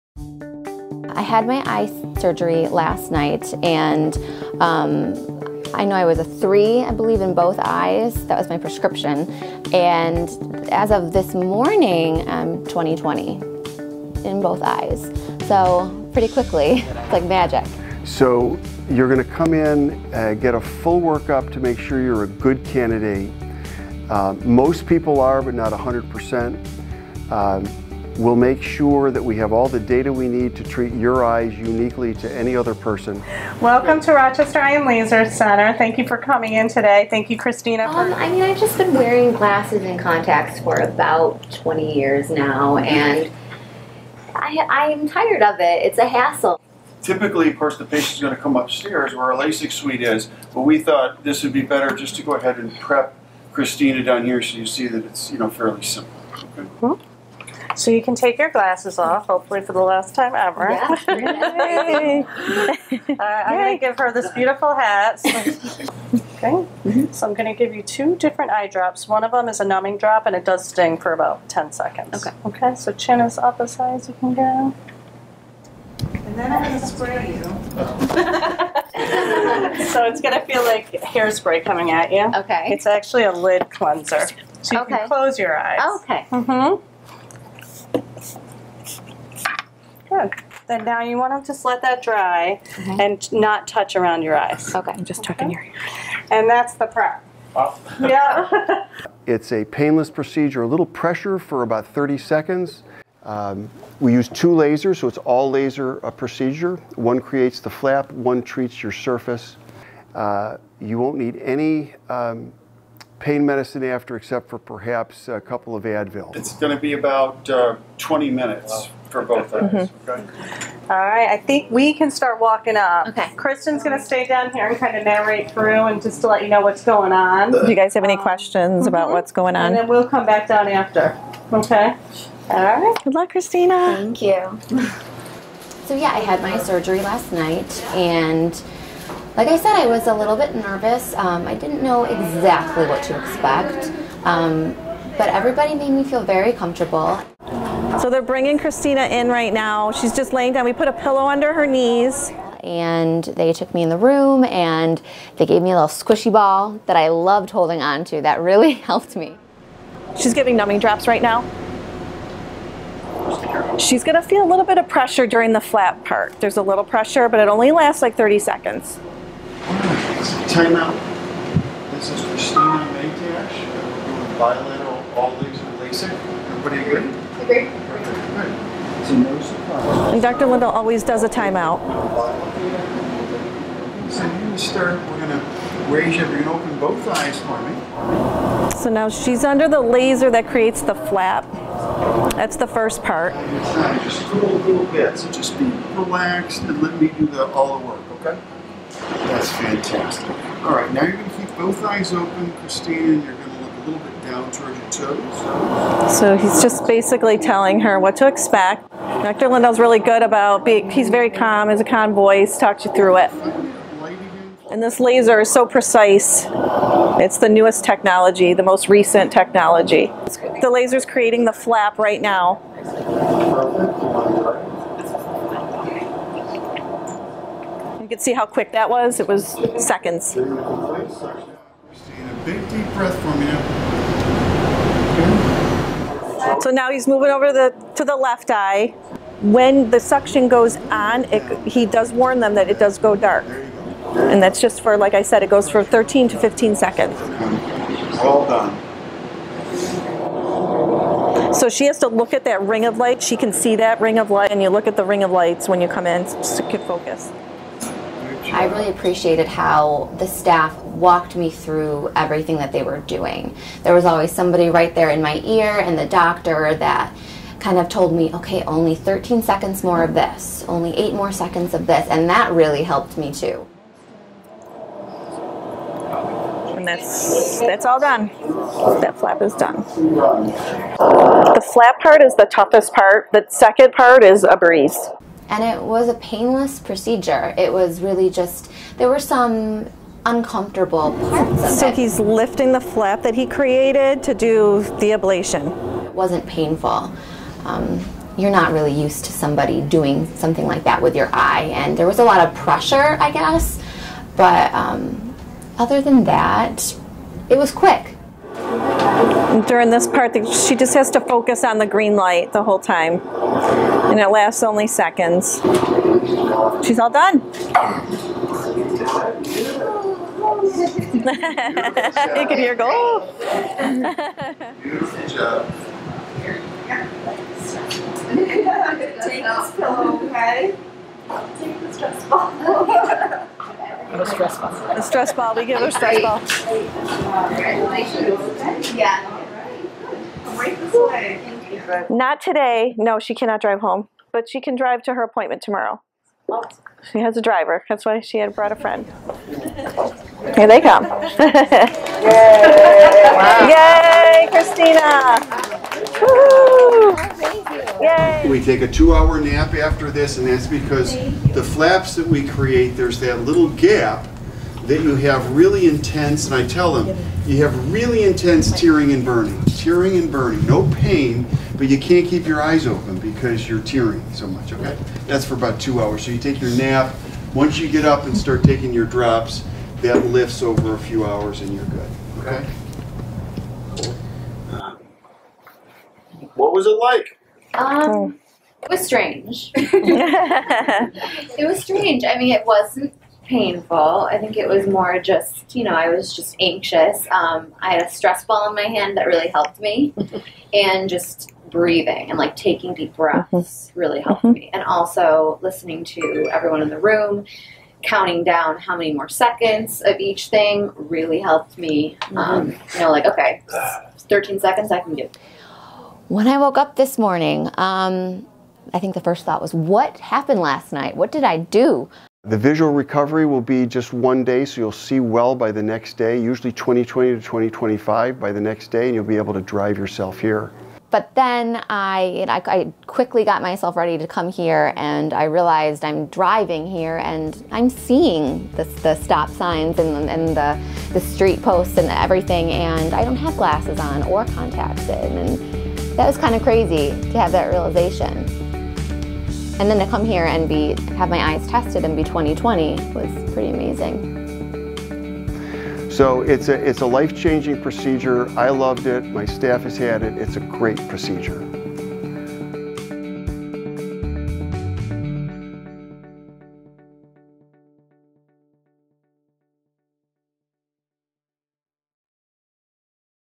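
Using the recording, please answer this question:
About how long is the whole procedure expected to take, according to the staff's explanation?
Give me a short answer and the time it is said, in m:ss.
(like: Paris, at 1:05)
20 minutes, at 1:57.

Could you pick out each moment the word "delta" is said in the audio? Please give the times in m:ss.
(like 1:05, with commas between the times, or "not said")
not said.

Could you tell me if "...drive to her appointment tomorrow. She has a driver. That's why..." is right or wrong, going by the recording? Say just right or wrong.
right.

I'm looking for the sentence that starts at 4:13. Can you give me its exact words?
She can see that ring of light, and you look at the ring of lights when you come in to focus.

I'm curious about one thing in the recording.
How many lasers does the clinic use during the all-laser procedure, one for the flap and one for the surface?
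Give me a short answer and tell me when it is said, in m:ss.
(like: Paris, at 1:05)
2, at 1:44.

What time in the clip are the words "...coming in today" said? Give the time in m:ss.
0:36.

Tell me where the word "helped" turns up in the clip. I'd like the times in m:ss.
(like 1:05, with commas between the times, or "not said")
2:38, 4:32, 6:39, 6:44, 6:51.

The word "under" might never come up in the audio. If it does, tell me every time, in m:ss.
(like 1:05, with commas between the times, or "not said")
2:31, 3:09.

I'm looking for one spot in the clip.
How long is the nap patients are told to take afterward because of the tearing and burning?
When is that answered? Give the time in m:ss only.
5:58.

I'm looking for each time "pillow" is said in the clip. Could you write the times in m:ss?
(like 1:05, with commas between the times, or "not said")
2:30, 5:29.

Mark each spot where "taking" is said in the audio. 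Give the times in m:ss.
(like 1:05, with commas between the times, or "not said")
6:18, 6:42.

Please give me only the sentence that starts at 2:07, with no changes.
Do you guys have any um, questions about mm-hmm.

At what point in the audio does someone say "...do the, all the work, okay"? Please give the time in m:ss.
3:17.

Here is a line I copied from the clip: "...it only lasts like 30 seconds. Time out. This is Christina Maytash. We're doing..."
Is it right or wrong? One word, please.
right.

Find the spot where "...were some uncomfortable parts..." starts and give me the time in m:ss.
4:49.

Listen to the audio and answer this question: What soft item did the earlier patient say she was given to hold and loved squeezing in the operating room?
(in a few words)
squishy ball.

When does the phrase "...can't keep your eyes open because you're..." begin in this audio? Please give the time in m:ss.
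6:11.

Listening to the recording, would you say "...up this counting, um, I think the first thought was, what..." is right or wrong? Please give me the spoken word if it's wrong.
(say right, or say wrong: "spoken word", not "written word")
wrong: "morning", not "counting".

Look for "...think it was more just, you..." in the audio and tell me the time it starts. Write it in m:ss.
6:34.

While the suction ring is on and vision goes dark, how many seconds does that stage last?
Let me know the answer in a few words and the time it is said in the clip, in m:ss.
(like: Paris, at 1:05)
13 to 15 seconds, at 4:05.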